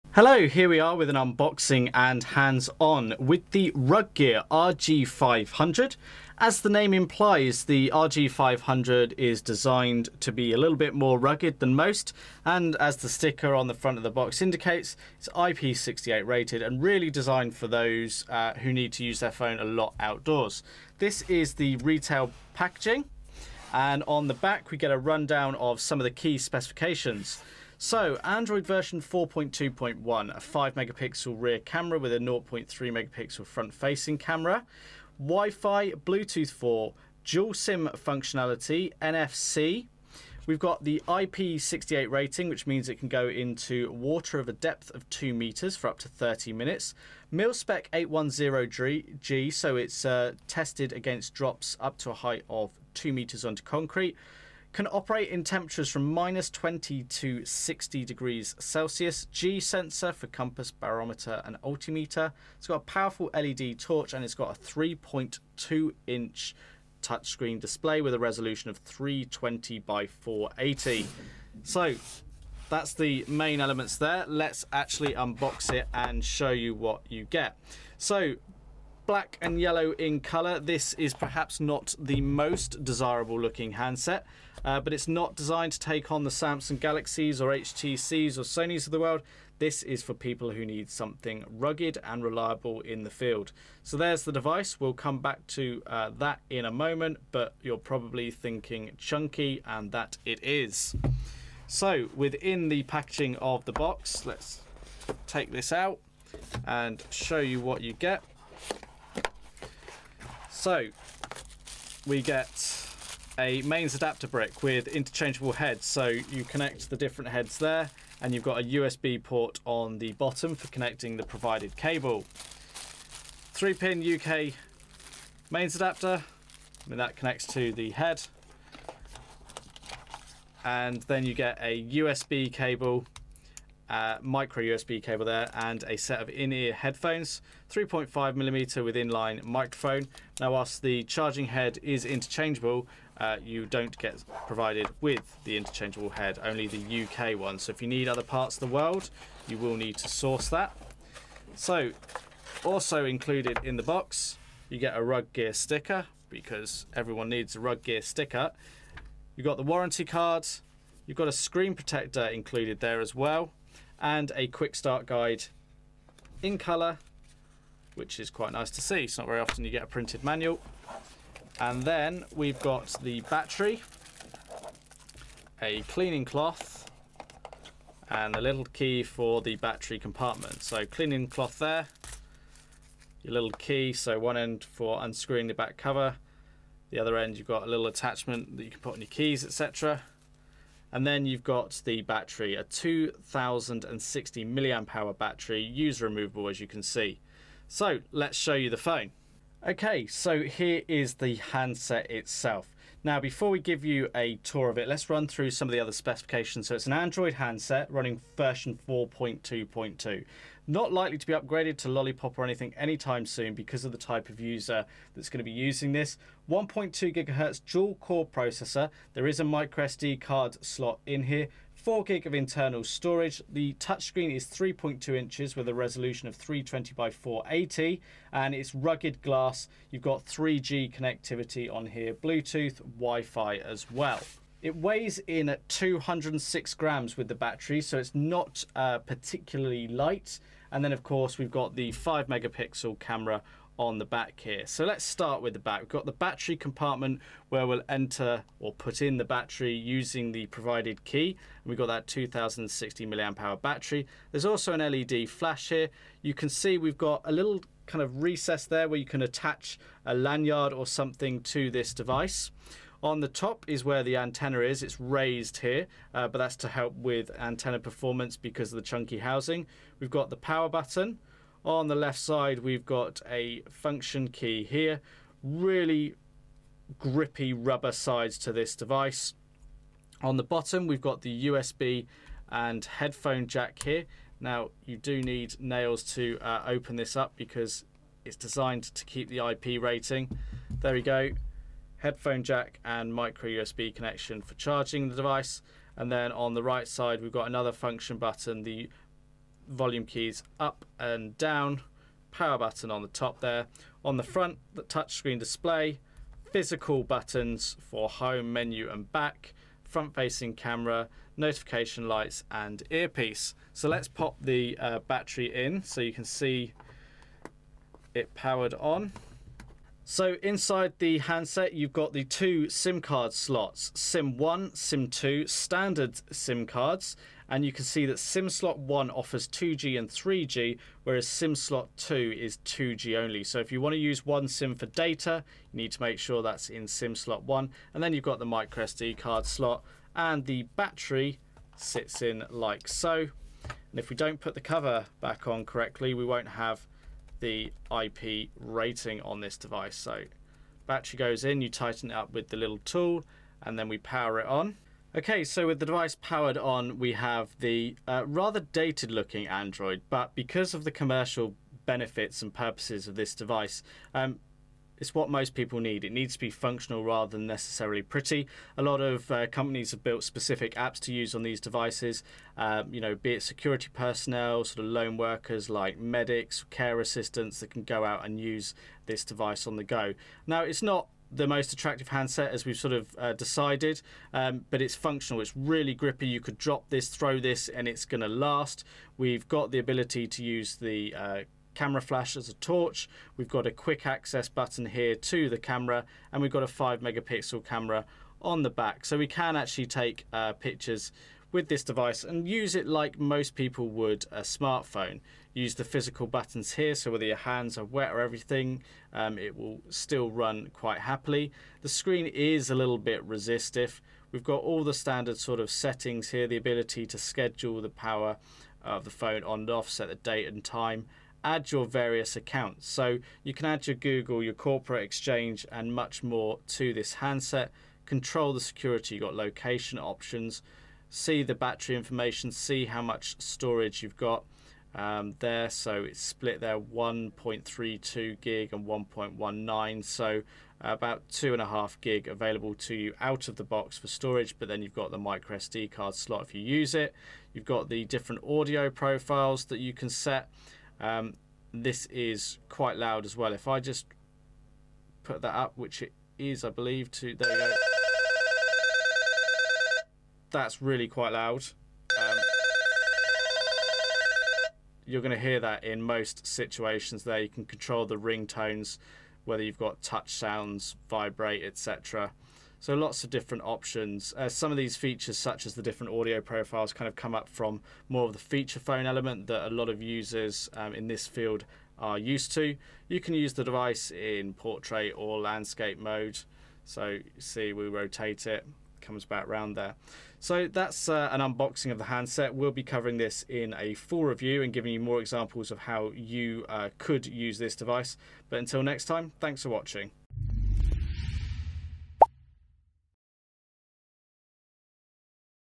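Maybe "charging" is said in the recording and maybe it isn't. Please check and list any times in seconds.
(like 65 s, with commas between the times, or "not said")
141 s, 294 s.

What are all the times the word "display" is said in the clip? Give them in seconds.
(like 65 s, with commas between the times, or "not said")
67 s, 305 s.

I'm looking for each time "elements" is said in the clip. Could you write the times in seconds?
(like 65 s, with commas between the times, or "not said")
73 s, 479 s.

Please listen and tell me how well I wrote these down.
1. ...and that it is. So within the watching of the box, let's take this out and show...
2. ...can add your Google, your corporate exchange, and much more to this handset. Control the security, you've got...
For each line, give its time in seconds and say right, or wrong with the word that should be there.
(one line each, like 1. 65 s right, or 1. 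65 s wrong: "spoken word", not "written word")
1. 99 s wrong: "packaging", not "watching"
2. 423 s right.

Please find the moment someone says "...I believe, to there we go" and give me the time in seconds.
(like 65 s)
456 s.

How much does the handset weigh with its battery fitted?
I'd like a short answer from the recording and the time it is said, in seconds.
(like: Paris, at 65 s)
206 grams, at 235 s.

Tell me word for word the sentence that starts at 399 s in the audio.
So we can actually take uh, pictures with this device and use it like most people would a smartphone.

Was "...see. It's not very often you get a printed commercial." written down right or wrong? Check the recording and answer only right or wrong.
wrong.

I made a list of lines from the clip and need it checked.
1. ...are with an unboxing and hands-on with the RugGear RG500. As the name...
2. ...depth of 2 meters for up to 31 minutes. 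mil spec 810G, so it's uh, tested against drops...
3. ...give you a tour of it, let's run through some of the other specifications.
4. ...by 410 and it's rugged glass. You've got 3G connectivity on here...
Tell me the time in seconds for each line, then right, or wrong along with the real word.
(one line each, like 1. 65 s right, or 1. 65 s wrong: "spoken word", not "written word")
1. 0 s right
2. 44 s wrong: "30", not "31"
3. 203 s right
4. 226 s wrong: "480", not "410".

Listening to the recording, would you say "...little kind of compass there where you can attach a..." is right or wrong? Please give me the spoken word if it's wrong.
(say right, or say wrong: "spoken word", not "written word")
wrong: "recess", not "compass".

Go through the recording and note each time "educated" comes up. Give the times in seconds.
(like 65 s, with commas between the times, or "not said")
not said.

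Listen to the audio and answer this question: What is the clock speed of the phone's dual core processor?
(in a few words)
1.2 gigahertz.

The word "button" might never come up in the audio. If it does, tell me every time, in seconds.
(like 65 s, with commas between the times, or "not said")
270 s, 298 s, 302 s, 307 s, 394 s, 406 s.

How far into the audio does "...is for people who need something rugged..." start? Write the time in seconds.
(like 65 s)
89 s.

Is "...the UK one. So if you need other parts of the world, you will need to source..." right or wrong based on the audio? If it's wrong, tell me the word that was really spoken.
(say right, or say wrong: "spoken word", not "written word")
right.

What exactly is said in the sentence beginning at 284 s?
Now, you do need nails to uh, open this up because it's designed to keep the IP rating.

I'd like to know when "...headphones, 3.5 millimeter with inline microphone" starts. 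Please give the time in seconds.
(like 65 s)
136 s.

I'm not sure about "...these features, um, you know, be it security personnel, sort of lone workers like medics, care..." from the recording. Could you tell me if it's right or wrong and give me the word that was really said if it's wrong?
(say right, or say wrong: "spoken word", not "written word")
wrong: "devices", not "features".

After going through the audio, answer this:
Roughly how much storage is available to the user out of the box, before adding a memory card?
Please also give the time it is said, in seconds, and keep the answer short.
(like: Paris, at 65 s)
about 2.5 gig, at 440 s.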